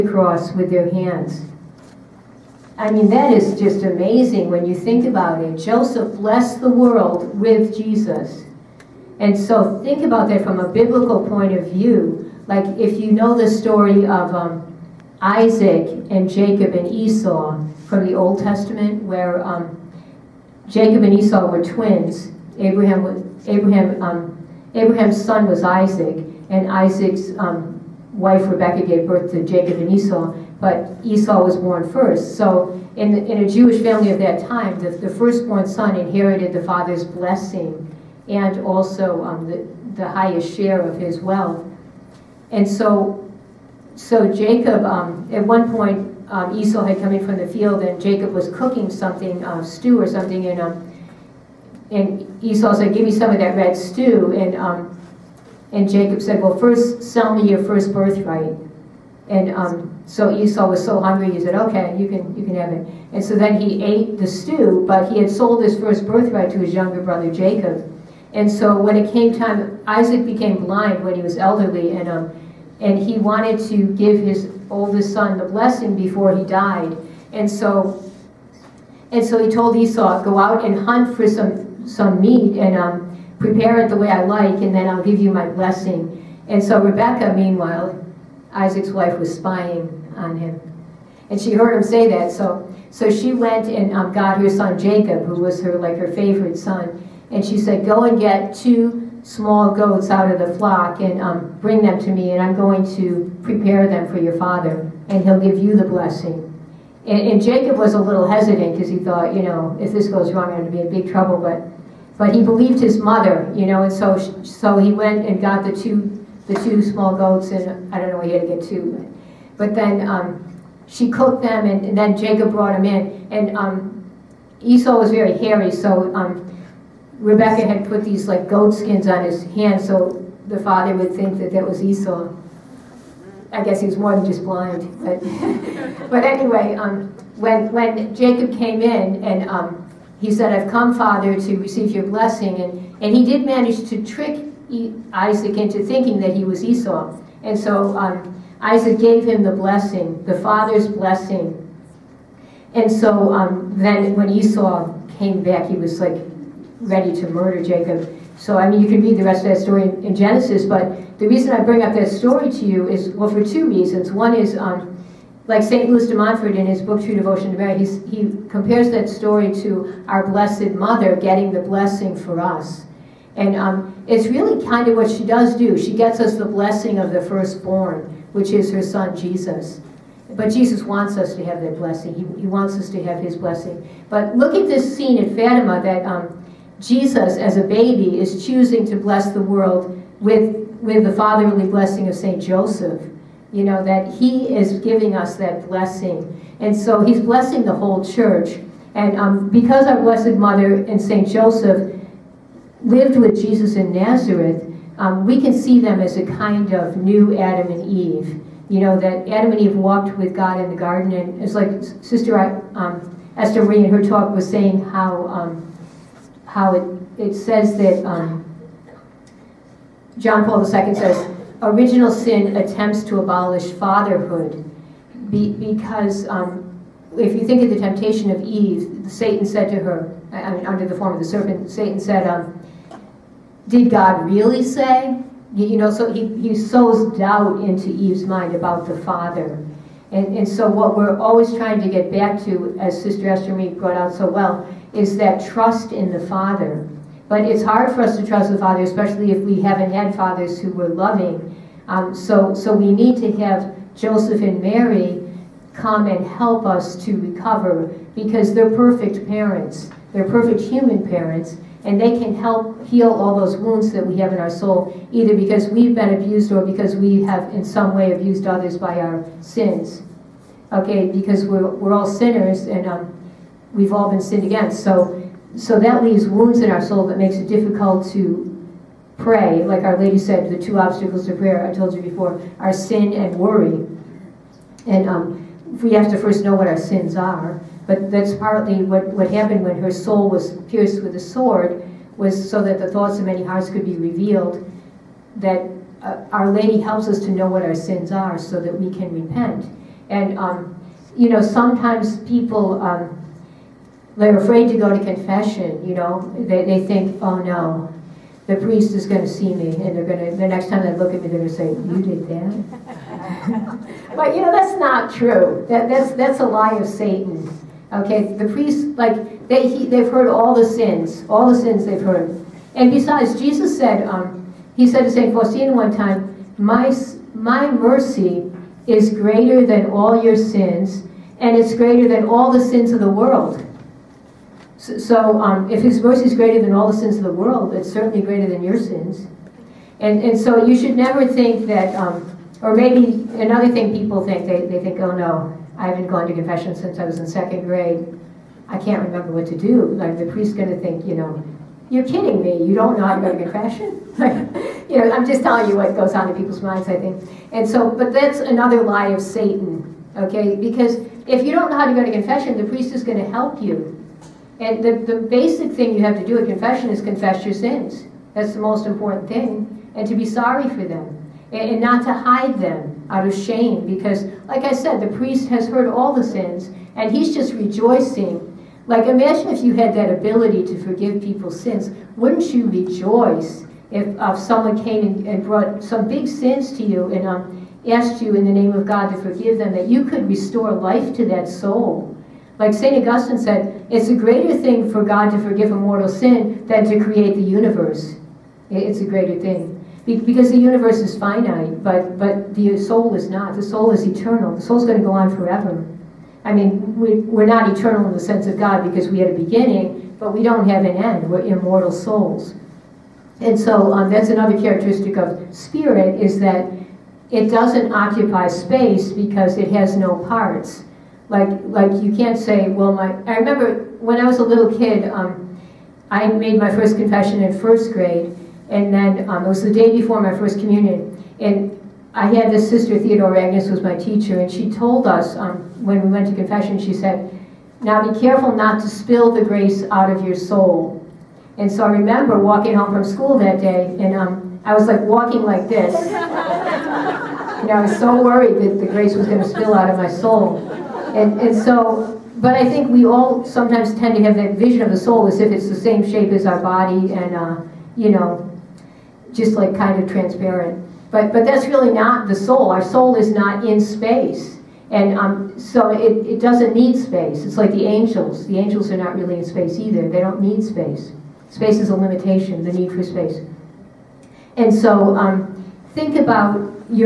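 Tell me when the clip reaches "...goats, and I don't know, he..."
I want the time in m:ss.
1:57.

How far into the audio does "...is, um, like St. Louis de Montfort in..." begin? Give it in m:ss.
2:44.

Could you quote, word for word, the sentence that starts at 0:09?
And so think about that from a biblical point of view.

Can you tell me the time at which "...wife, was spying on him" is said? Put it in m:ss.
1:28.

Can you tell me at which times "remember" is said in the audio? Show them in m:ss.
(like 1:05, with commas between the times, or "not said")
5:49, 7:03, 7:21.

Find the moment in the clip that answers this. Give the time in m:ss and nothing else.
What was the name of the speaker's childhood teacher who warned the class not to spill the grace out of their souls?
7:12.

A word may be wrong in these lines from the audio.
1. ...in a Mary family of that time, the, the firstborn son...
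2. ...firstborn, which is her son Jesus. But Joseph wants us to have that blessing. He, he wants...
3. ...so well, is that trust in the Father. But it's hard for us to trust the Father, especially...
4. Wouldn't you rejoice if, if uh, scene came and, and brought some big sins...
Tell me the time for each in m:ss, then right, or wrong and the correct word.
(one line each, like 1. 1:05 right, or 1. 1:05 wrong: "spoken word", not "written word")
1. 0:33 wrong: "Jewish", not "Mary"
2. 2:57 wrong: "Jesus", not "Joseph"
3. 4:04 right
4. 6:22 wrong: "someone", not "scene".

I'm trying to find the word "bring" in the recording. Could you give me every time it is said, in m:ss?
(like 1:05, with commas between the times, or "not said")
1:41, 2:41.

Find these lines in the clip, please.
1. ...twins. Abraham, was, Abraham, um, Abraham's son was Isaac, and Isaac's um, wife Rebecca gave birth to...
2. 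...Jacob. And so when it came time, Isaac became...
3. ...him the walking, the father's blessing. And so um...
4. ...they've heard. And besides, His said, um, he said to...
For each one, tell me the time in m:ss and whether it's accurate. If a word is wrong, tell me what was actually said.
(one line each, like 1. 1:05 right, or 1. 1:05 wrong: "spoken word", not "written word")
1. 0:21 right
2. 1:07 right
3. 2:29 wrong: "blessing", not "walking"
4. 5:21 wrong: "Jesus", not "His".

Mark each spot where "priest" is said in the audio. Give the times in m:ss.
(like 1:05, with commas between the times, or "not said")
5:08, 5:18, 5:50, 6:02, 6:15.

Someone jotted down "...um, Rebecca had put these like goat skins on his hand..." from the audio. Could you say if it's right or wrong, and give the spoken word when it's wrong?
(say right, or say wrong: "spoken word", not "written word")
right.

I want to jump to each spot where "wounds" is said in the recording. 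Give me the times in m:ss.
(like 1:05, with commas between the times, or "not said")
4:23, 4:36.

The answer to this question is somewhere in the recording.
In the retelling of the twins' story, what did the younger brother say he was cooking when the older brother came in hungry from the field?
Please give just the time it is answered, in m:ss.
0:53.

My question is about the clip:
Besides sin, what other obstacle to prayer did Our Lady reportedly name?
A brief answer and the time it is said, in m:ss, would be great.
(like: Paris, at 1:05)
worry, at 4:43.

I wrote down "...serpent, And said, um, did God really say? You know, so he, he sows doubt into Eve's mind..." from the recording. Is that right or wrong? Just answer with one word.
wrong.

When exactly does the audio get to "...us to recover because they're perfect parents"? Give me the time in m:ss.
4:16.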